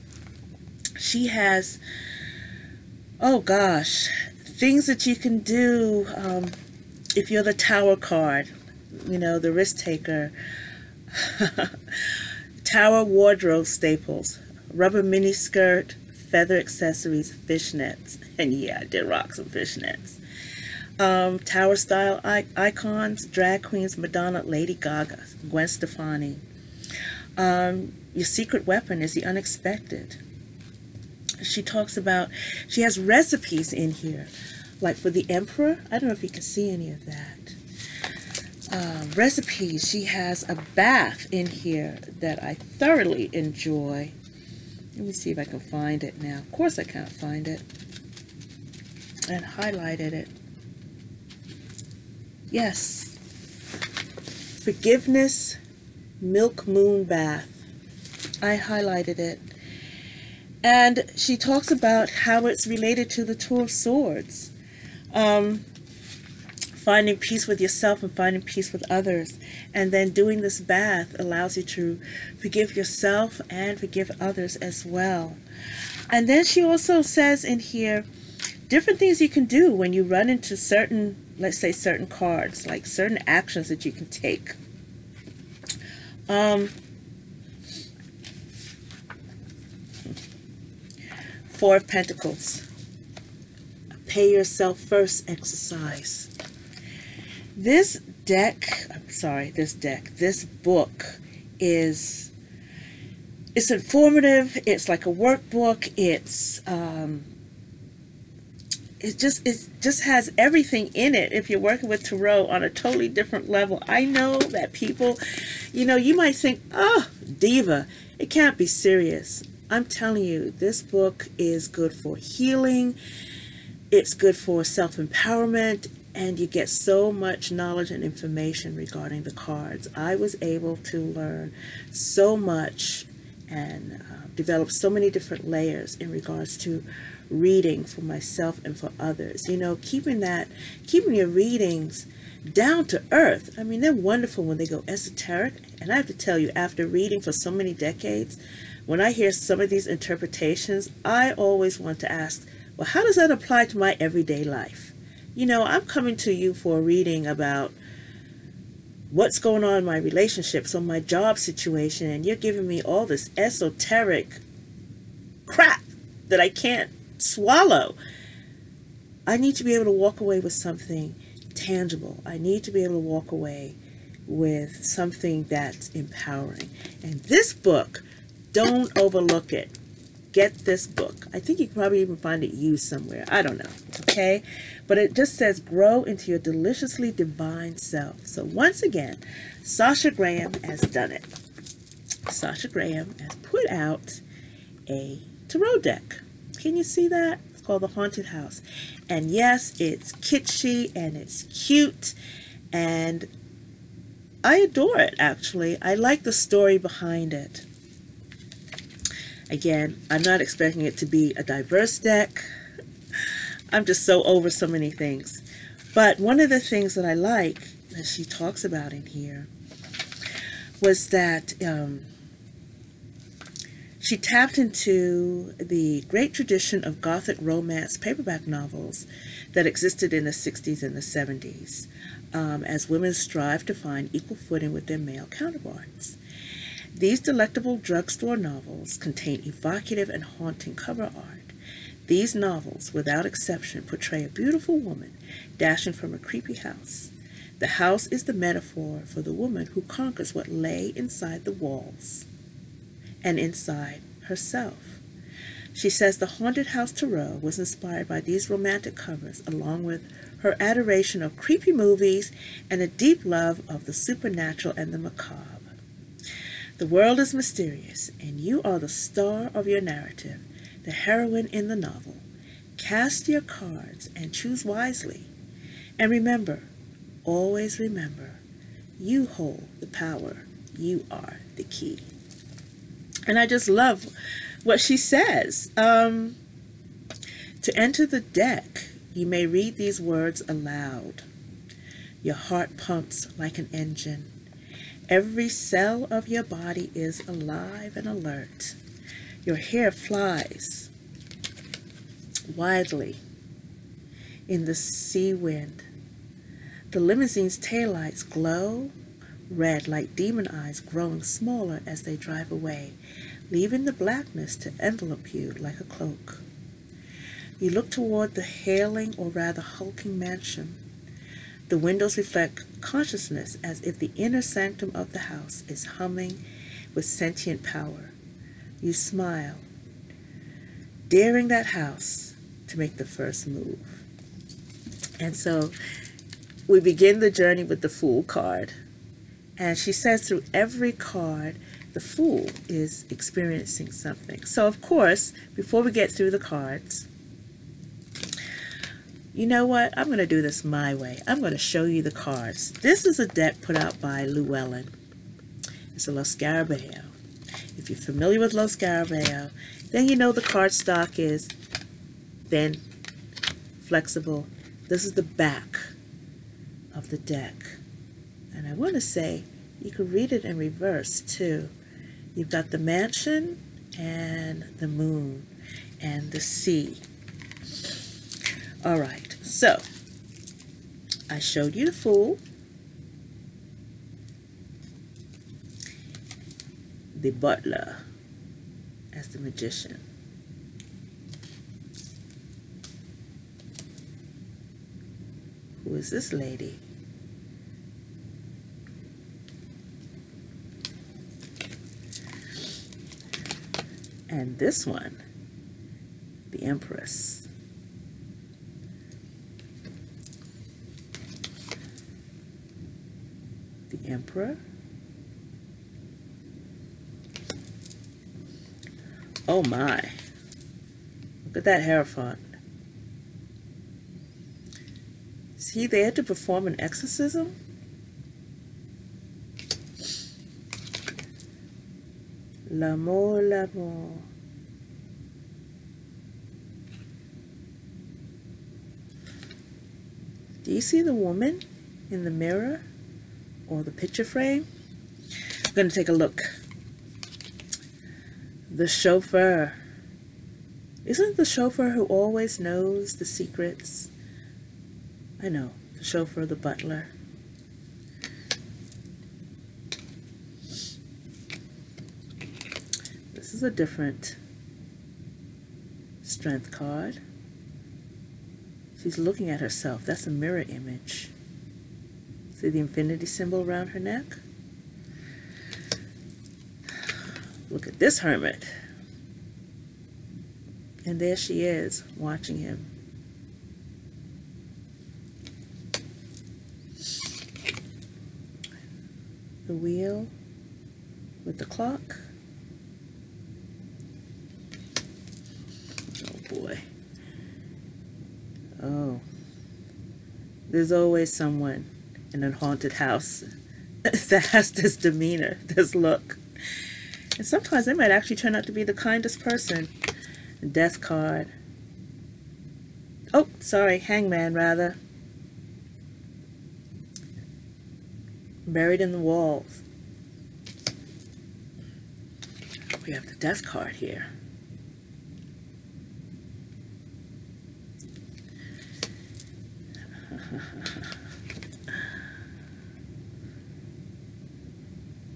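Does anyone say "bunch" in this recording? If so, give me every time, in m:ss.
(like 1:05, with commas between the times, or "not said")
not said.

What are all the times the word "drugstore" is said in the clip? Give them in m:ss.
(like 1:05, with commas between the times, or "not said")
3:57.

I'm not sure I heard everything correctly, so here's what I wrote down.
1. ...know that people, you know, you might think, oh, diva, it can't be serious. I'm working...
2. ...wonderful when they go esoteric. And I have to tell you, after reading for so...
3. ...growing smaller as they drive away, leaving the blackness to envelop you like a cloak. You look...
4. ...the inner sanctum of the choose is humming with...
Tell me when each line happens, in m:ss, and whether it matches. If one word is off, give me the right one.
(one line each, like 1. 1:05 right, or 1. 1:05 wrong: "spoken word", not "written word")
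1. 1:54 wrong: "telling", not "working"
2. 2:23 right
3. 5:10 right
4. 5:23 wrong: "house", not "choose".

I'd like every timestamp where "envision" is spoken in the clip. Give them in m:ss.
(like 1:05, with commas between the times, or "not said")
not said.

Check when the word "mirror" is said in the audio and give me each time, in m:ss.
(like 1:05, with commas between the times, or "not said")
7:22, 7:50.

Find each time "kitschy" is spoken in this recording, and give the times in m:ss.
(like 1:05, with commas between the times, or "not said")
3:20.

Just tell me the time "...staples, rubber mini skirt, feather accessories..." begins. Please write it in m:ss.
0:13.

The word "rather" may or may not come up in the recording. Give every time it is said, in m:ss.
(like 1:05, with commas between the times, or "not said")
5:19, 8:34.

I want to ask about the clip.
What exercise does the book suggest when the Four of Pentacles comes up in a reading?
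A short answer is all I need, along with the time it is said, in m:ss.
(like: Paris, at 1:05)
Pay yourself first, at 1:34.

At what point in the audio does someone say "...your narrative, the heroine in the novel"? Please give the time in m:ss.
4:29.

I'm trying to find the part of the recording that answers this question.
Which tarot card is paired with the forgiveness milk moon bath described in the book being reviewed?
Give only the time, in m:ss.
1:03.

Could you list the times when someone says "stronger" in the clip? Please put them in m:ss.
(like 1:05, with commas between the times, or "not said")
not said.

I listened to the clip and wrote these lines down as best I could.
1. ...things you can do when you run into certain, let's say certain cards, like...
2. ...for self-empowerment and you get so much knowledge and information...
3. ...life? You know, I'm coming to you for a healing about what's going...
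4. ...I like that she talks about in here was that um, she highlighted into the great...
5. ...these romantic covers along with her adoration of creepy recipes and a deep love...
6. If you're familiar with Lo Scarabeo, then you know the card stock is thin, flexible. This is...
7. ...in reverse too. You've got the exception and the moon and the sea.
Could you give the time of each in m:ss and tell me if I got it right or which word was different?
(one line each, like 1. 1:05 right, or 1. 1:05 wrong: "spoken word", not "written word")
1. 1:18 right
2. 2:04 right
3. 2:34 wrong: "reading", not "healing"
4. 3:37 wrong: "tapped", not "highlighted"
5. 4:18 wrong: "movies", not "recipes"
6. 5:57 right
7. 6:10 wrong: "mansion", not "exception".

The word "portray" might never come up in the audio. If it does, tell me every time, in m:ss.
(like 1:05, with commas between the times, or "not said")
4:03.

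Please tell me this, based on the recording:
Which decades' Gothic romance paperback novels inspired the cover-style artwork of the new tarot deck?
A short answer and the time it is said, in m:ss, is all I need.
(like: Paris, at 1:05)
60s and 70s, at 3:50.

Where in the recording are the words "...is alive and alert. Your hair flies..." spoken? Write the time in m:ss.
4:56.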